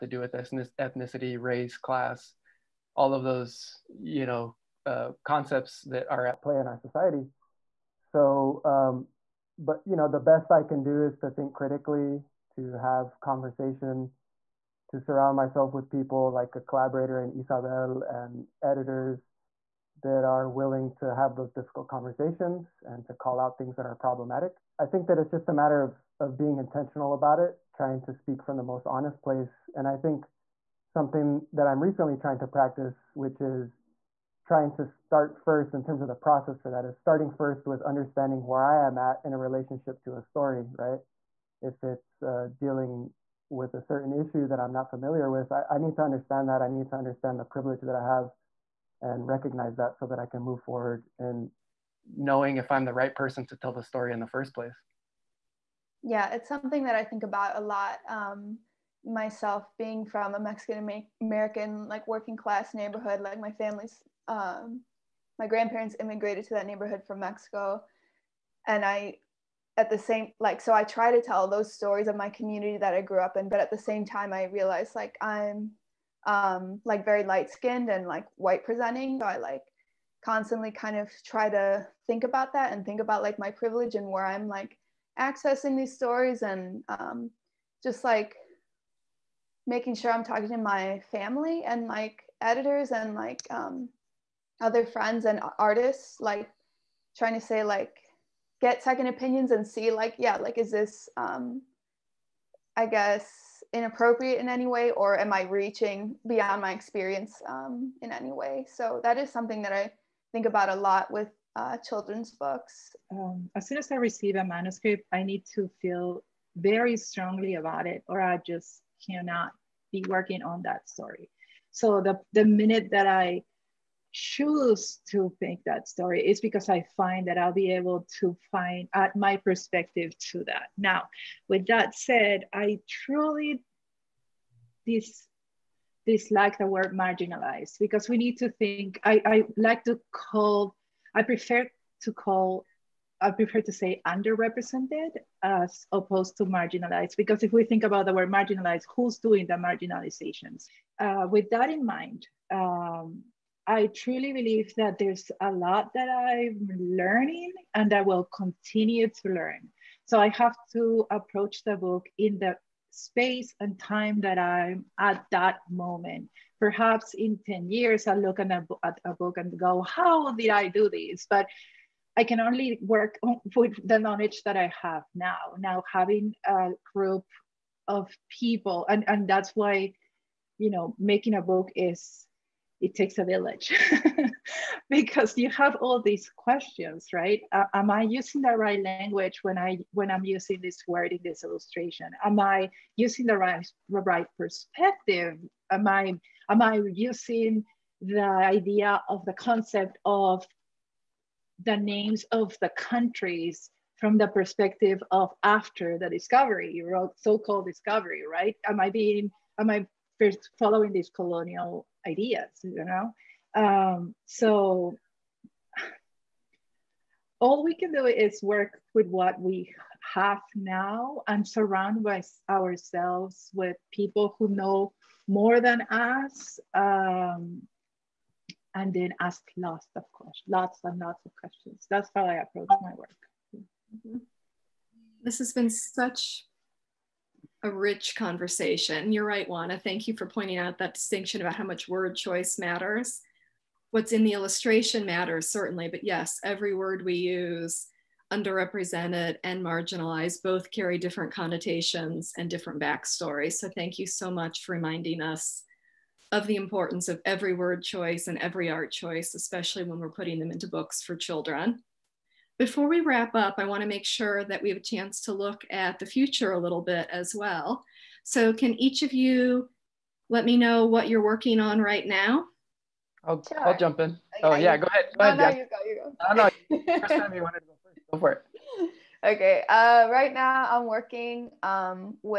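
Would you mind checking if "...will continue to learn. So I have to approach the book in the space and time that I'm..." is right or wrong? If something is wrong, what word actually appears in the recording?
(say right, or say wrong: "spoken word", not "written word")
right.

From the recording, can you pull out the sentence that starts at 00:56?
Yeah, it's something that I think about a lot.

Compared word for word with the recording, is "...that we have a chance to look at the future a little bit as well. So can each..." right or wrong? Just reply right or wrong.
right.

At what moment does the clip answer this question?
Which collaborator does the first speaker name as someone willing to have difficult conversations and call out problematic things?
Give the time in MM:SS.
00:17.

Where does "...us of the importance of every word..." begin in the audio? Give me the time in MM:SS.
04:15.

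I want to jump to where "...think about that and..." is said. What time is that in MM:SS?
01:22.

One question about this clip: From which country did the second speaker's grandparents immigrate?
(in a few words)
Mexico.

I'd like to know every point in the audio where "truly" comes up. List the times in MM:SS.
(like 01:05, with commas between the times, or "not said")
02:12, 02:33.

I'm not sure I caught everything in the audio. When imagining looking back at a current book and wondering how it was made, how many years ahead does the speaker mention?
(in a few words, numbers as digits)
10.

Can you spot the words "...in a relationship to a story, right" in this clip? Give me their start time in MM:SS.
00:39.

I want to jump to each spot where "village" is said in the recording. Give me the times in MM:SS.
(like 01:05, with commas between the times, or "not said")
03:03.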